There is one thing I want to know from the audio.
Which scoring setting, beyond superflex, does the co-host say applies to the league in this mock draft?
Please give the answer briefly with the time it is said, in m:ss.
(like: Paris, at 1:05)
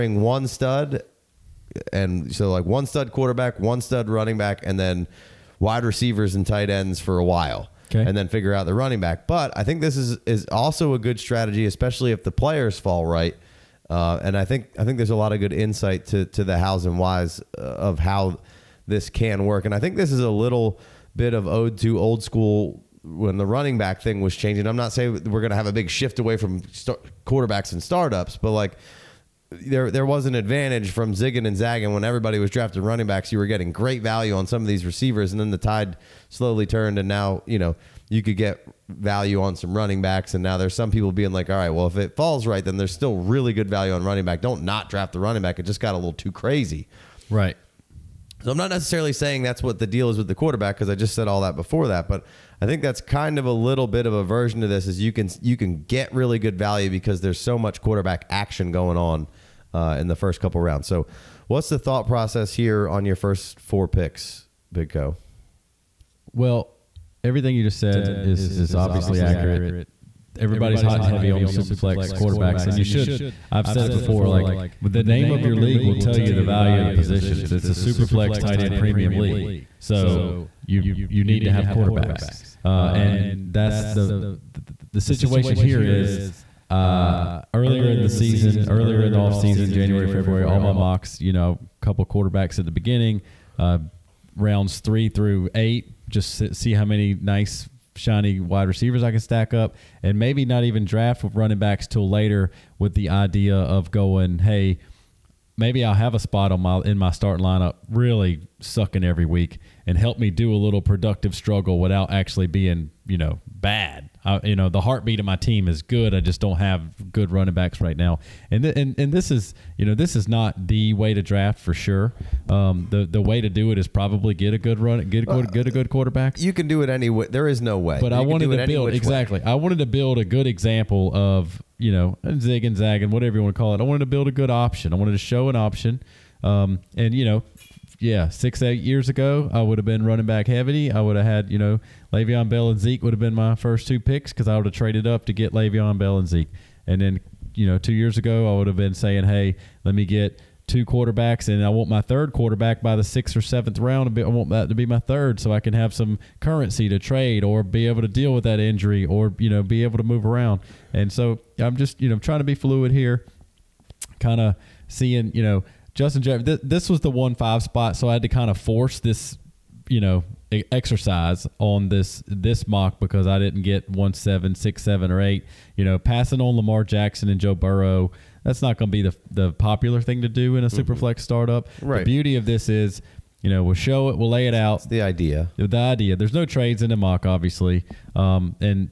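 tight end premium, at 1:18.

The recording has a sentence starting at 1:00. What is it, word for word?
So, what's the thought process here on your first four picks, Big Co?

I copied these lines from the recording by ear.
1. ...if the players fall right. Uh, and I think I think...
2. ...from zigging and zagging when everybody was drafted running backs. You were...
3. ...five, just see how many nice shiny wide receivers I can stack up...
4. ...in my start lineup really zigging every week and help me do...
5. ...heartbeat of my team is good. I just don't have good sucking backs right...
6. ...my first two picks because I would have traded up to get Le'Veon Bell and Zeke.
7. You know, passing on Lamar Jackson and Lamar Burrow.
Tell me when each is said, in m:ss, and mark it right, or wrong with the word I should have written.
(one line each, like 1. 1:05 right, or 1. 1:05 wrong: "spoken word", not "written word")
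1. 0:12 right
2. 0:30 right
3. 1:35 wrong: "eight", not "five"
4. 1:46 wrong: "sucking", not "zigging"
5. 1:54 wrong: "running", not "sucking"
6. 2:23 right
7. 2:55 wrong: "Joe", not "Lamar".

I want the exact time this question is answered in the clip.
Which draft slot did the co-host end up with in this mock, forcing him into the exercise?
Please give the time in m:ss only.
2:47.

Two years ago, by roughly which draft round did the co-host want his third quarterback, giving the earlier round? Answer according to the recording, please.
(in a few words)
6th.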